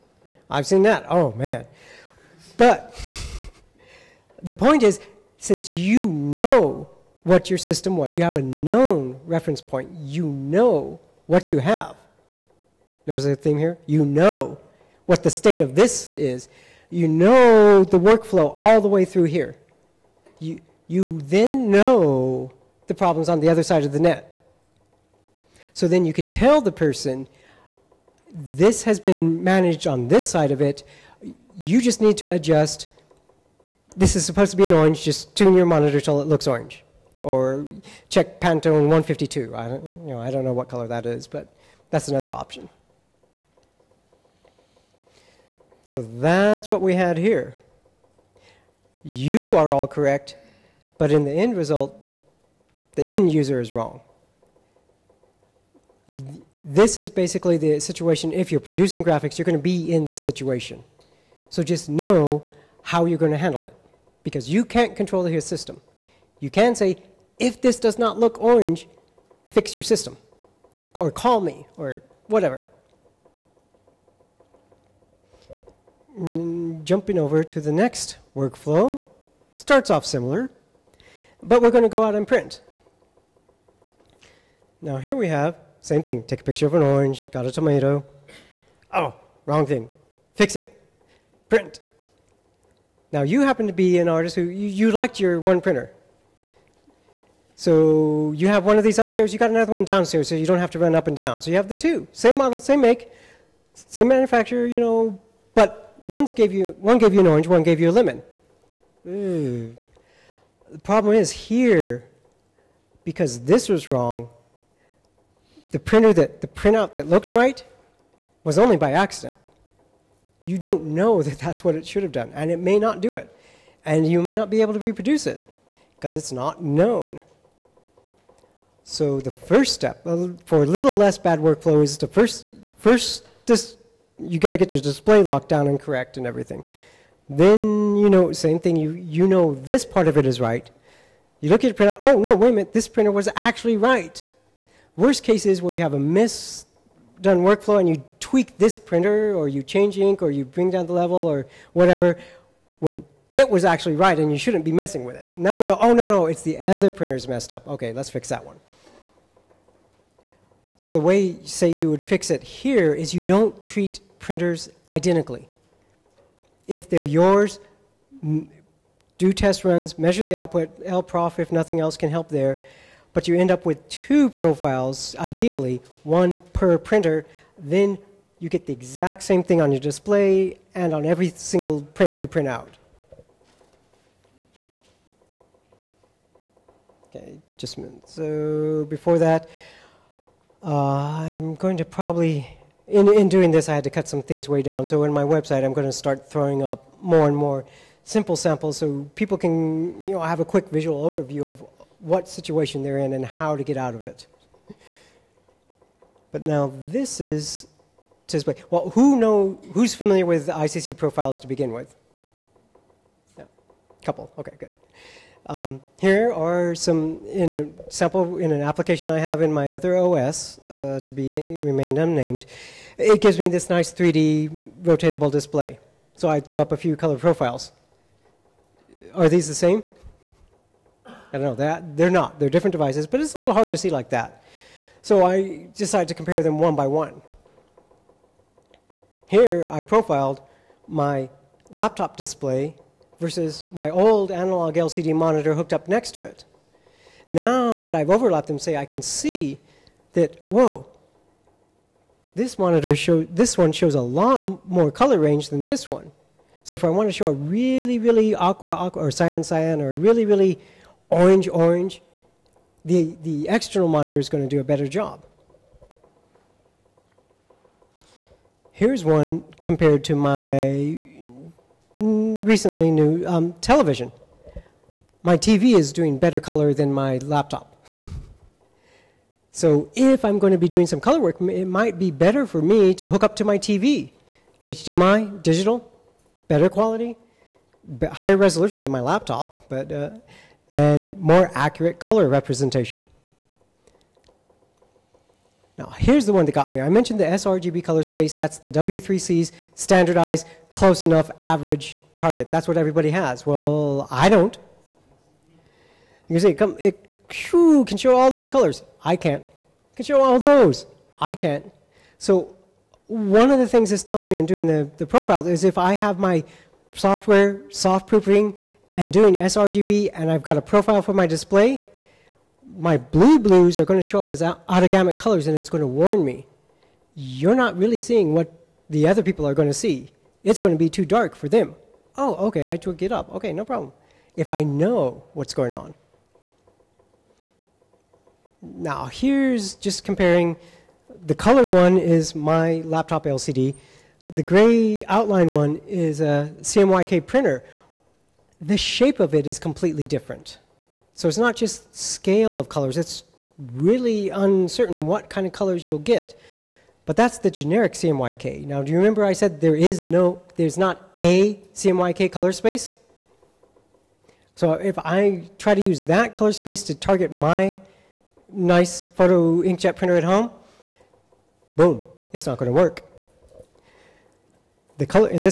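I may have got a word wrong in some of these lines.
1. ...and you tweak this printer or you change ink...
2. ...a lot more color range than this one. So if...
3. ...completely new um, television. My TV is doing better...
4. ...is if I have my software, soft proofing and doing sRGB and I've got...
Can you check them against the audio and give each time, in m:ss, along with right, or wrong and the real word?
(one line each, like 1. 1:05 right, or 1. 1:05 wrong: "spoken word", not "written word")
1. 2:27 right
2. 4:13 right
3. 4:31 wrong: "recently", not "completely"
4. 5:15 right.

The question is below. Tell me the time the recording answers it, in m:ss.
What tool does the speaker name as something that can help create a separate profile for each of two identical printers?
2:50.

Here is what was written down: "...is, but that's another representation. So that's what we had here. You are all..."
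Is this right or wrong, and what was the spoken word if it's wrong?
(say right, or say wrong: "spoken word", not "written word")
wrong: "option", not "representation".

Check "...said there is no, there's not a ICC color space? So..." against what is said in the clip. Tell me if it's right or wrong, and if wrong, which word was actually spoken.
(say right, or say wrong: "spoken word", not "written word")
wrong: "CMYK", not "ICC".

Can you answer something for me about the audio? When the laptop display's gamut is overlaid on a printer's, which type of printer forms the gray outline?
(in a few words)
CMYK printer.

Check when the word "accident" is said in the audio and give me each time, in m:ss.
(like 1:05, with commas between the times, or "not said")
1:58.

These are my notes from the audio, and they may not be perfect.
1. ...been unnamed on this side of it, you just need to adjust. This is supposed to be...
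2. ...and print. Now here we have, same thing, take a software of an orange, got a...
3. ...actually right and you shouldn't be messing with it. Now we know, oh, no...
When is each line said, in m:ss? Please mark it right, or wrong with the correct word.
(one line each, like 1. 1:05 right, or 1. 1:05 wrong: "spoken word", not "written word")
1. 0:28 wrong: "managed", not "unnamed"
2. 1:22 wrong: "picture", not "software"
3. 2:33 right.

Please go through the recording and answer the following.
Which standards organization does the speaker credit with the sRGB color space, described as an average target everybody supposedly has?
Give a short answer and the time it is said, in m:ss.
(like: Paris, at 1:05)
W3C, at 4:58.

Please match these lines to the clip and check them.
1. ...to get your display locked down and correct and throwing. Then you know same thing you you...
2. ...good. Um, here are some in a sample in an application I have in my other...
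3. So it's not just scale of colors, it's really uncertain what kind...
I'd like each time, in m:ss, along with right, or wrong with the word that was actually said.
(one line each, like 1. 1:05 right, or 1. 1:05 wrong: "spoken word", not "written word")
1. 2:14 wrong: "everything", not "throwing"
2. 3:34 right
3. 5:51 right.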